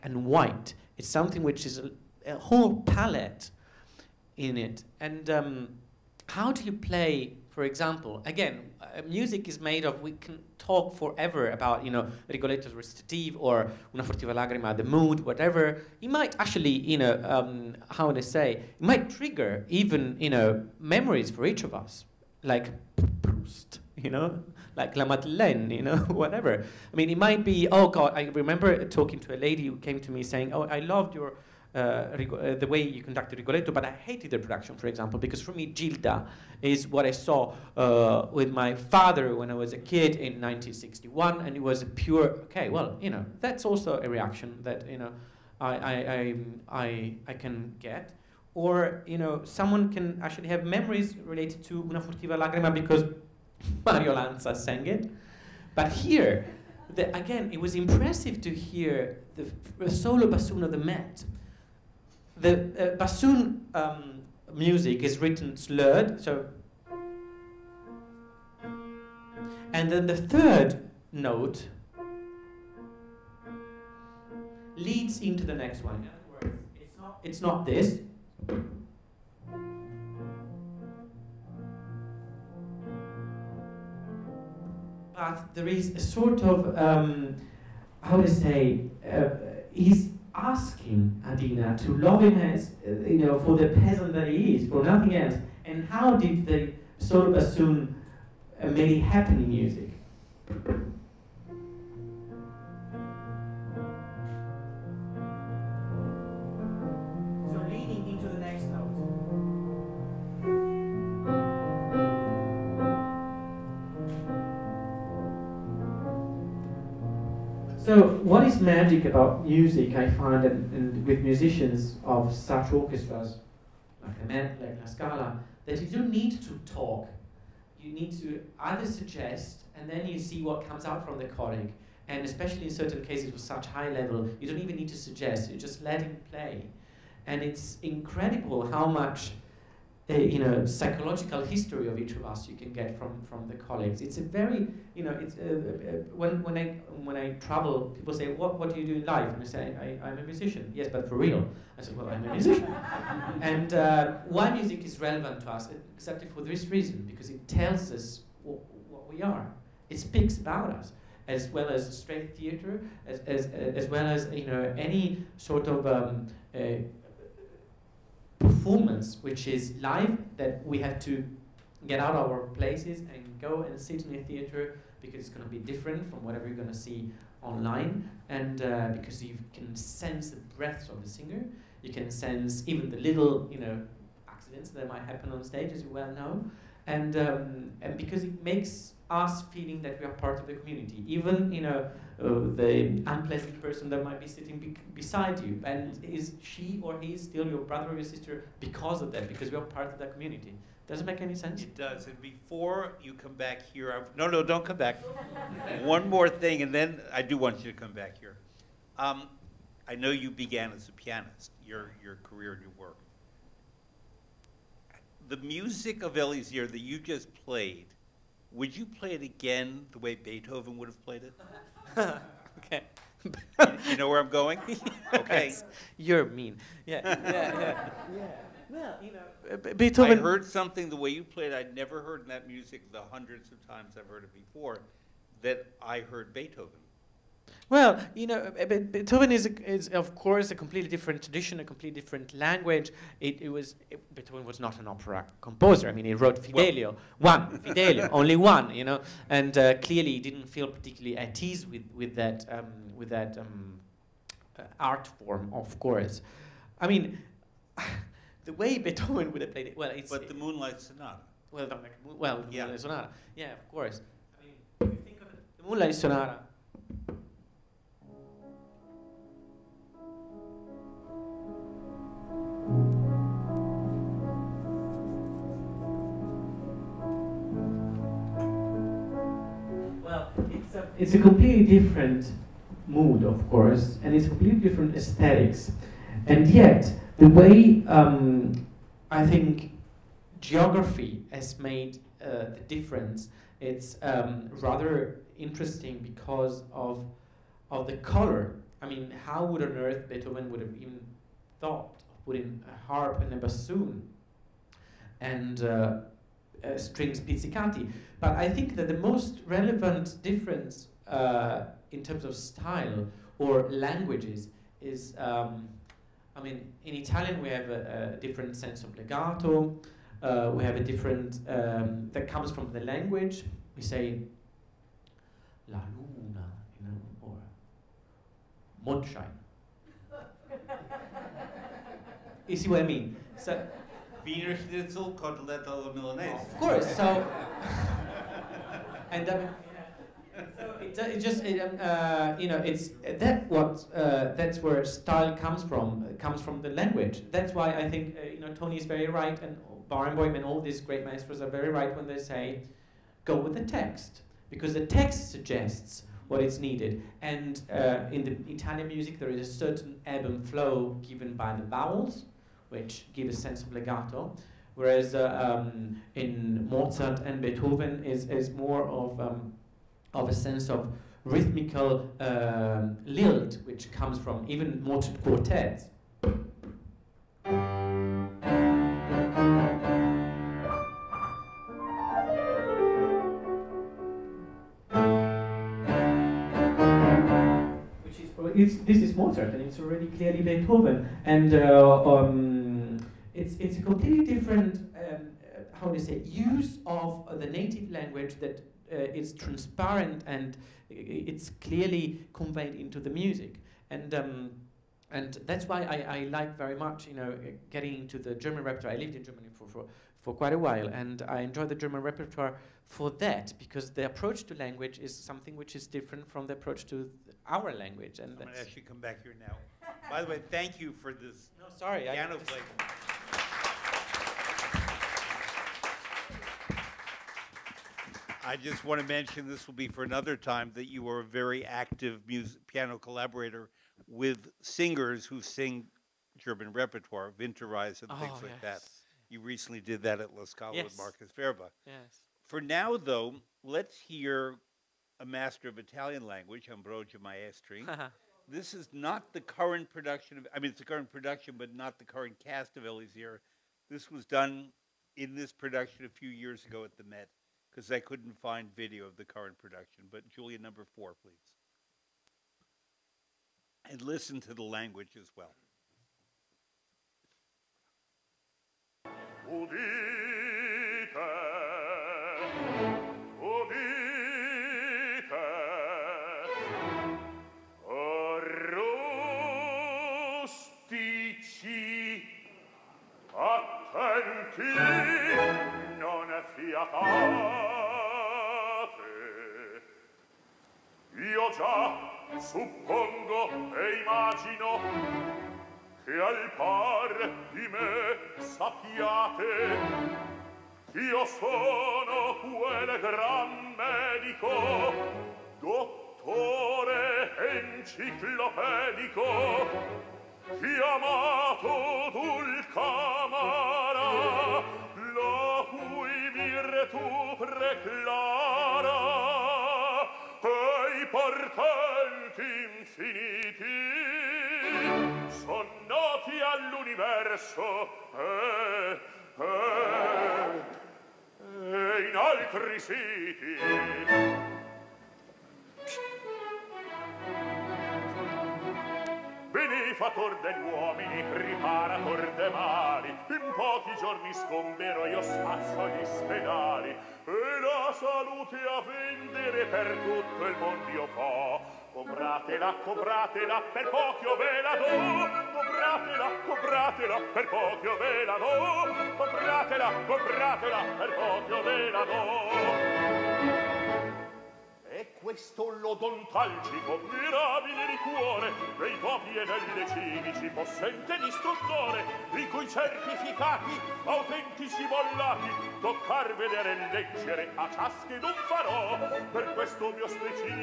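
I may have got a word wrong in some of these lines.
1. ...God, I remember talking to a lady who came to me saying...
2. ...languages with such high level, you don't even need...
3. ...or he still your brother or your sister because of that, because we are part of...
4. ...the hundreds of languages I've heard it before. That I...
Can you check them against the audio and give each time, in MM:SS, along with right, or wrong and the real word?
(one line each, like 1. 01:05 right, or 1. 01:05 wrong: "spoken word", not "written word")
1. 00:27 right
2. 02:13 wrong: "cases", not "languages"
3. 03:16 right
4. 03:52 wrong: "times", not "languages".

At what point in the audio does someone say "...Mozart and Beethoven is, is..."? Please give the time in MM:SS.
06:06.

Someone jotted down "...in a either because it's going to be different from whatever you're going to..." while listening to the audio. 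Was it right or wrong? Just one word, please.
wrong.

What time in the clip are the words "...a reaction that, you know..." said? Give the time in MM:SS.
00:44.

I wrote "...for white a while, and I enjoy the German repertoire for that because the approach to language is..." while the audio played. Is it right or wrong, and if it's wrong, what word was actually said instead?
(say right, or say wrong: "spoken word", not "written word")
wrong: "quite", not "white".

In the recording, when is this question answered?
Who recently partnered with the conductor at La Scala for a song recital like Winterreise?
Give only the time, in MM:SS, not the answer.
07:20.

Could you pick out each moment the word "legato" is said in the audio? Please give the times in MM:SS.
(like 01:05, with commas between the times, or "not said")
05:18, 06:03.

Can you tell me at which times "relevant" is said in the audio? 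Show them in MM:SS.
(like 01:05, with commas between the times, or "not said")
02:35, 05:09.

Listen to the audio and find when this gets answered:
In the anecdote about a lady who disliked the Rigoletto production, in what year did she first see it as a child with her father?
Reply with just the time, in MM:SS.
00:40.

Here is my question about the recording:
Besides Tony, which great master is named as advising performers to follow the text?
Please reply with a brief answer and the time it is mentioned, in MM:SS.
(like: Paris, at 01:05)
Barenboim, at 05:49.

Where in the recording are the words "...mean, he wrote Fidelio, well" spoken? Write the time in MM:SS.
04:05.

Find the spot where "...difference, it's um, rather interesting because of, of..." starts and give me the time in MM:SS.
04:52.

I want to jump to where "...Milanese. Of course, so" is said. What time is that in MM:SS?
05:35.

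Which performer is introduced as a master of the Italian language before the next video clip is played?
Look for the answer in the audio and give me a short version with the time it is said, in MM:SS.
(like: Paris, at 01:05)
Ambrogio Maestri, at 07:26.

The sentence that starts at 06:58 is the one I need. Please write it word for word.
And I'm going to actually come back here now.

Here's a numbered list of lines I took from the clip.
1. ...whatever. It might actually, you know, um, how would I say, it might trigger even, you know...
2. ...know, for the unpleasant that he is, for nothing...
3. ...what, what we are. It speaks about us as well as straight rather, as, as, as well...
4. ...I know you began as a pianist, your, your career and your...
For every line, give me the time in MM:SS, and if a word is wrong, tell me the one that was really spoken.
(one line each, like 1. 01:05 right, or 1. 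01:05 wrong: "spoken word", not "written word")
1. 00:15 right
2. 01:33 wrong: "peasant", not "unpleasant"
3. 02:38 wrong: "theater", not "rather"
4. 03:29 right.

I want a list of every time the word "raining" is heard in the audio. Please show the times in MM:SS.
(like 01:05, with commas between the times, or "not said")
not said.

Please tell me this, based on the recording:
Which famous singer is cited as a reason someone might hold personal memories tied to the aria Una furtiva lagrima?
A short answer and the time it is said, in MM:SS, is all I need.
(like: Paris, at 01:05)
Mario Lanza, at 00:53.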